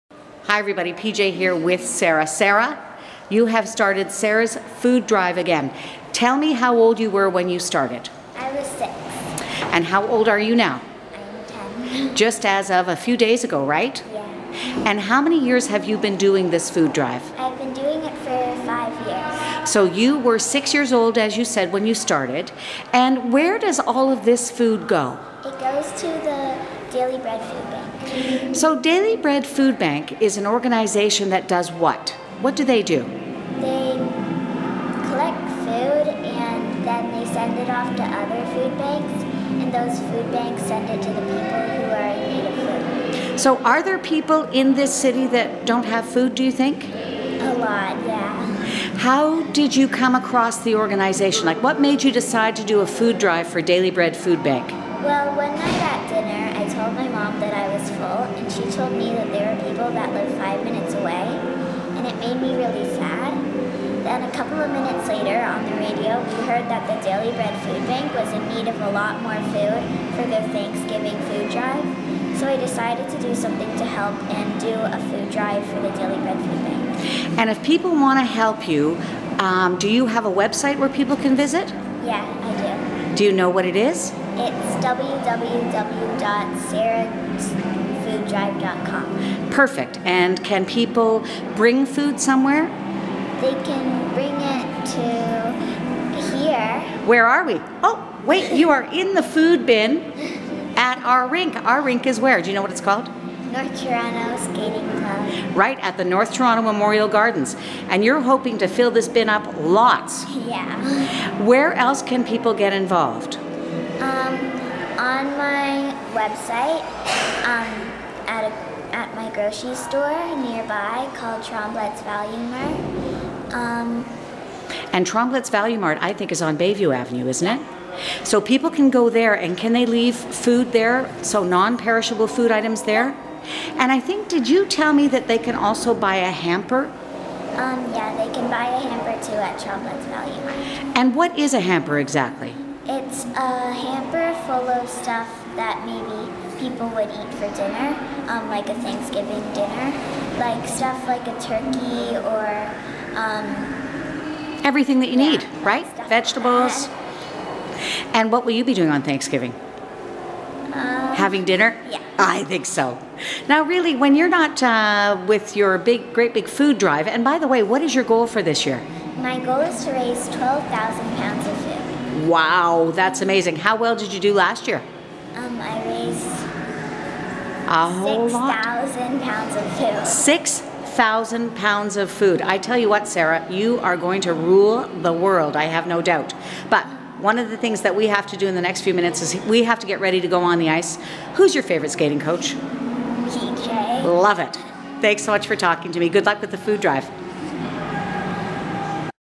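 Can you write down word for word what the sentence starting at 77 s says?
And if people want to help you, um, do you have a website where people can visit?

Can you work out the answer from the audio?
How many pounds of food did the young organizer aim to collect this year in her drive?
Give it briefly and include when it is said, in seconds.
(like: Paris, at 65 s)
12,000 pounds, at 170 s.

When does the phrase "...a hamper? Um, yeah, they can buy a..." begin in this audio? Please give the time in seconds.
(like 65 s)
136 s.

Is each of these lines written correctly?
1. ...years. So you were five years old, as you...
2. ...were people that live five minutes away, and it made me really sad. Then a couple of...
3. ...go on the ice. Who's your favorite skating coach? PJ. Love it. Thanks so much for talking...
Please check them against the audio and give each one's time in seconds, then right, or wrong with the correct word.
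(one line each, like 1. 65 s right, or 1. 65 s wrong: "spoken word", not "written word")
1. 19 s wrong: "six", not "five"
2. 59 s right
3. 190 s right.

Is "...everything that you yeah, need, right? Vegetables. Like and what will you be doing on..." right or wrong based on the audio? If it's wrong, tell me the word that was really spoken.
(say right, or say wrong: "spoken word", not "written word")
right.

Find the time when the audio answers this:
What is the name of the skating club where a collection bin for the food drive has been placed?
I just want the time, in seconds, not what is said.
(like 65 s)
103 s.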